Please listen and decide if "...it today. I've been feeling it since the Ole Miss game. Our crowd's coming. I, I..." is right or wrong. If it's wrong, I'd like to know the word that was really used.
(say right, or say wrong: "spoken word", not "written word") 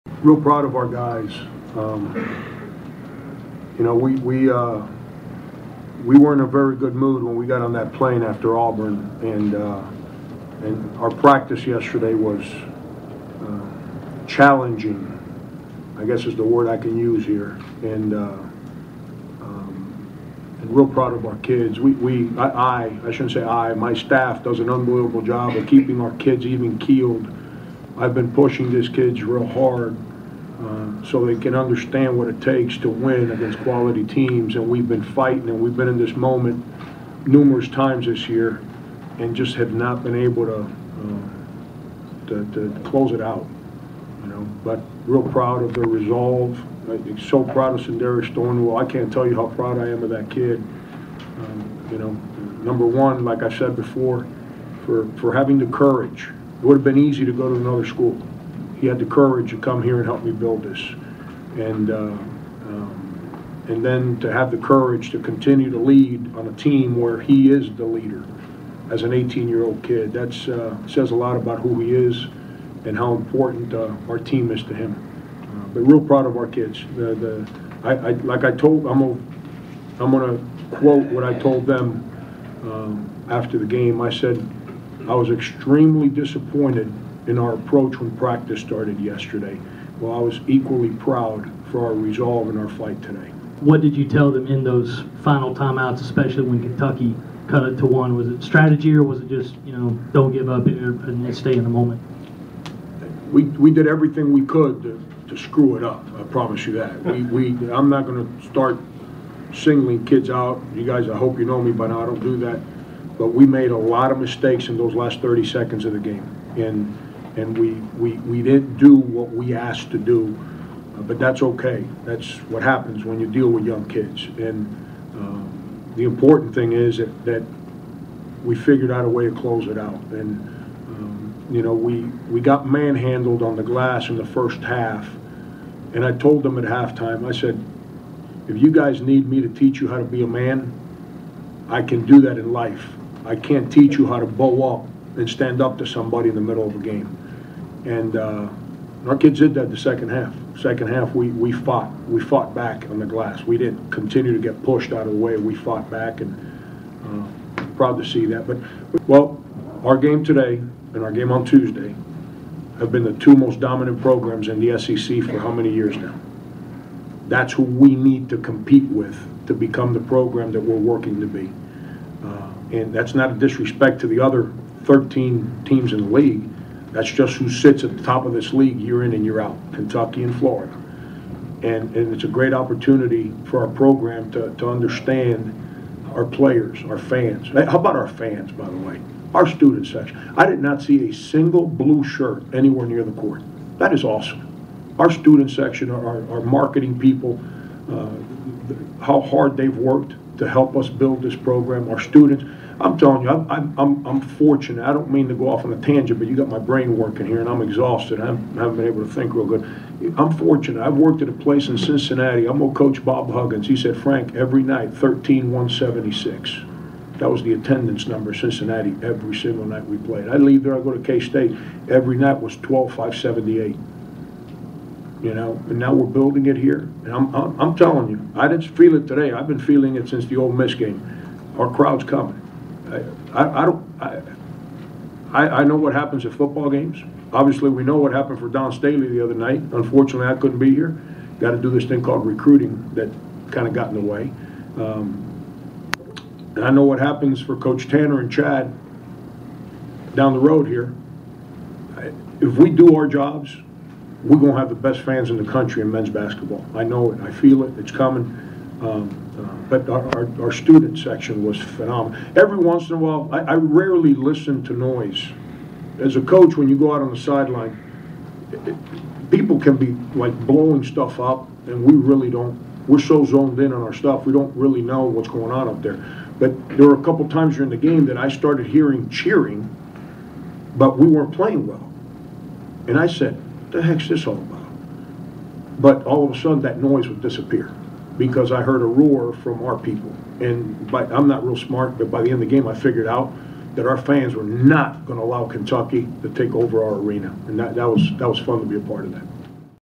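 right.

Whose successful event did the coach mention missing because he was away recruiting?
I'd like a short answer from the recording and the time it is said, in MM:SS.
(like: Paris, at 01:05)
Dawn Staley, at 03:58.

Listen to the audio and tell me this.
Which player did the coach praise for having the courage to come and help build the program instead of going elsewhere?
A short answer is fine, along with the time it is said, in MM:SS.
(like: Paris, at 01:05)
Sindarius Thornwell, at 00:47.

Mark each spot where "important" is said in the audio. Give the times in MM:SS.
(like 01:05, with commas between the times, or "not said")
01:13, 02:06.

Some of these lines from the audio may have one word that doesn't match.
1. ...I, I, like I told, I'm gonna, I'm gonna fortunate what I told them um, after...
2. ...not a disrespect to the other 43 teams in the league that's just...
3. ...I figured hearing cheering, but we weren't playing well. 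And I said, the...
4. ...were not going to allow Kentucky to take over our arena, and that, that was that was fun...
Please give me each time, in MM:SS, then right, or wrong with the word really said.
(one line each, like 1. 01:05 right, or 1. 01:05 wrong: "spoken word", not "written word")
1. 01:17 wrong: "quote", not "fortunate"
2. 02:53 wrong: "13", not "43"
3. 04:38 wrong: "started", not "figured"
4. 04:54 right.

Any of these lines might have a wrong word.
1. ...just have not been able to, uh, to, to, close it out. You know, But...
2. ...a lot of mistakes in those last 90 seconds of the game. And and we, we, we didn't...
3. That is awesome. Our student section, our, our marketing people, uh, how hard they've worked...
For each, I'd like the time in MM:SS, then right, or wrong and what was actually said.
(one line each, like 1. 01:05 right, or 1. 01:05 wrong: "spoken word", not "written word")
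1. 00:39 right
2. 01:53 wrong: "30", not "90"
3. 03:13 right.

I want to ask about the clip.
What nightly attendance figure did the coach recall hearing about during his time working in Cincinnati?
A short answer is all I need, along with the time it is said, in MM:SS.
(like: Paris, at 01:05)
13,176, at 03:34.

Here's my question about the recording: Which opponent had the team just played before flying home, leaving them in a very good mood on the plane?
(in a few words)
Auburn.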